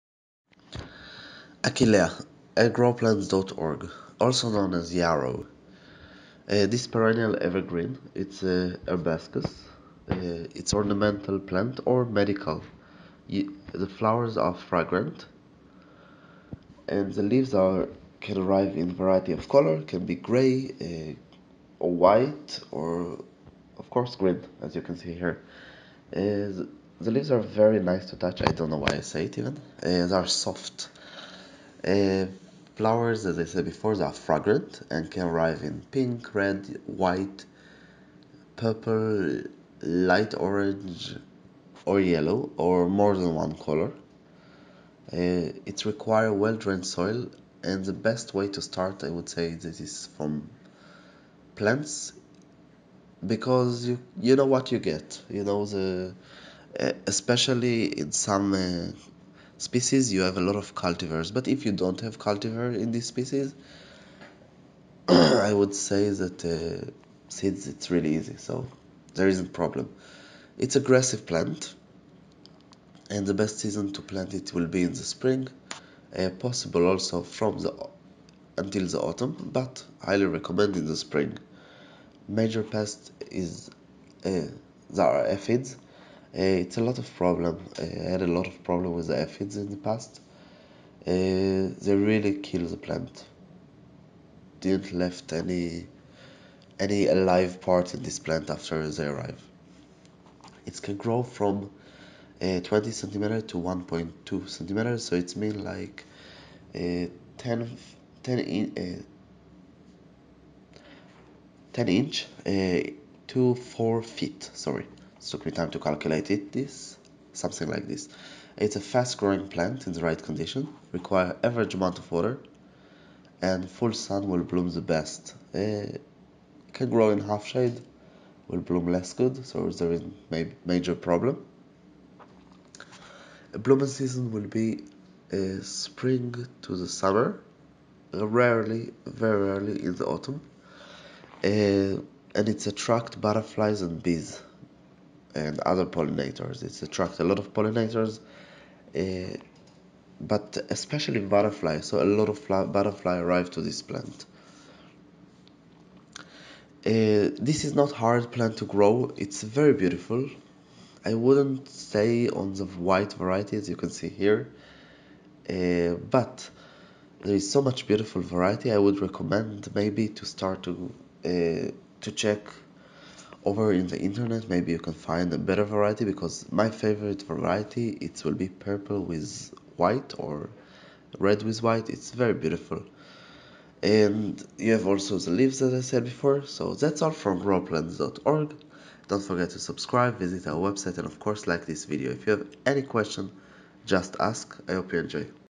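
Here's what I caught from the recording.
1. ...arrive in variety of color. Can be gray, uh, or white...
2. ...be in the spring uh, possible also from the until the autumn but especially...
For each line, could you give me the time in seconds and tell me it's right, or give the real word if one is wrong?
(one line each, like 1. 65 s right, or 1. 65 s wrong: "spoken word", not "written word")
1. 18 s right
2. 74 s wrong: "highly", not "especially".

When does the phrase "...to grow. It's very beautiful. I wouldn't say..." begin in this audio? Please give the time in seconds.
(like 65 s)
158 s.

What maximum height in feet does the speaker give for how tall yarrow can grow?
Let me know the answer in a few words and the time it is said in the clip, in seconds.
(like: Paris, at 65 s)
4 feet, at 113 s.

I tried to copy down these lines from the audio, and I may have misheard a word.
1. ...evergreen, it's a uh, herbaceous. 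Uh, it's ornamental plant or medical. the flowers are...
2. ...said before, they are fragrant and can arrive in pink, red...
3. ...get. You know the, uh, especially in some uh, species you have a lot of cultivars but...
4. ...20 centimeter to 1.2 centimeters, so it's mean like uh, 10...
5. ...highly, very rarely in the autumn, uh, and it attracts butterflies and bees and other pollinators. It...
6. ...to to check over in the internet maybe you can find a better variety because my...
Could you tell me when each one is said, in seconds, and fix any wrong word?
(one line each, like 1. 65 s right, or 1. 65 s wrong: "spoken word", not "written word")
1. 7 s right
2. 33 s right
3. 54 s right
4. 102 s right
5. 138 s wrong: "rarely", not "highly"
6. 170 s right.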